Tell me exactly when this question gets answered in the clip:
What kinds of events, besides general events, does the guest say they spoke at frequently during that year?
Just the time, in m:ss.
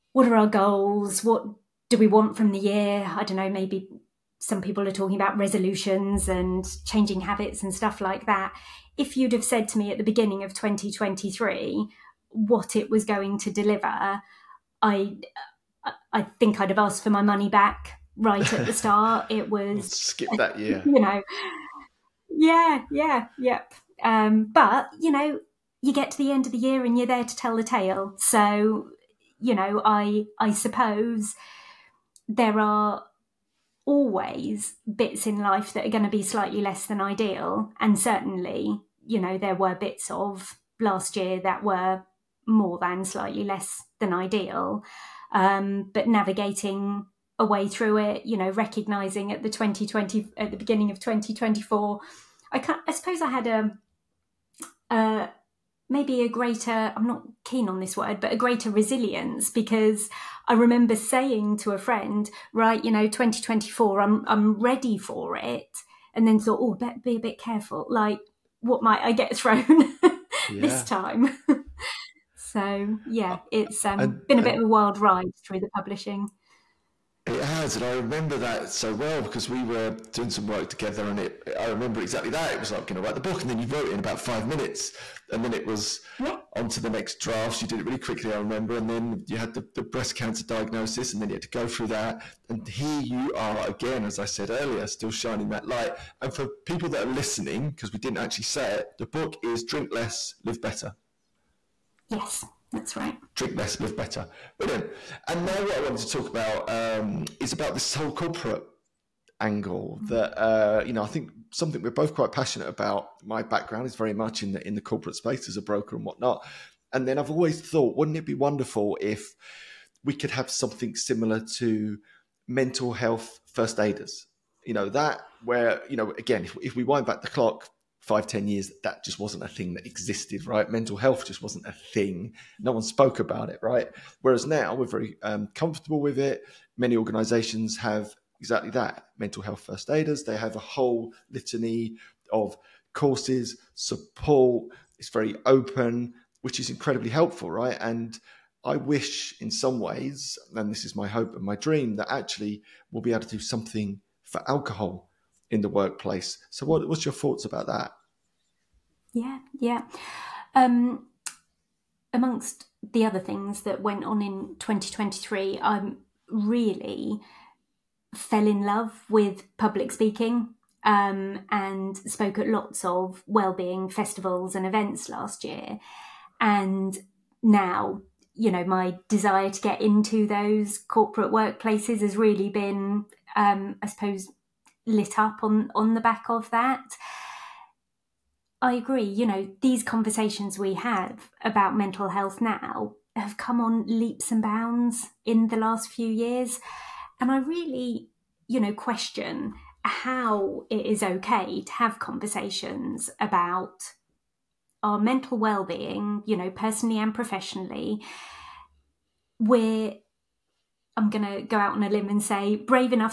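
2:53.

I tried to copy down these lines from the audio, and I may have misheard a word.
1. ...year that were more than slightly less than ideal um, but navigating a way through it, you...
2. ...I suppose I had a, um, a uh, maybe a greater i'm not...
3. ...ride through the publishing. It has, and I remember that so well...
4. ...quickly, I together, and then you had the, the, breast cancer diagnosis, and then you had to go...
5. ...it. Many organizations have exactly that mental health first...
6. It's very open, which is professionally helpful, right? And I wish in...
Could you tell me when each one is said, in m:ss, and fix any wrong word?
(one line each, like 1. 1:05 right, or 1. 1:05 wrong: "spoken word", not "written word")
1. 0:41 right
2. 0:52 right
3. 1:14 right
4. 1:27 wrong: "remember", not "together"
5. 2:16 right
6. 2:24 wrong: "incredibly", not "professionally".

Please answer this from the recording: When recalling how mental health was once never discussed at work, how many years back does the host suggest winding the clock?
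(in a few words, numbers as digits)
5, 10 years.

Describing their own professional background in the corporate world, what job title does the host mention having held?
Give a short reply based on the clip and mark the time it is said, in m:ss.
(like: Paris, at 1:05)
broker, at 1:55.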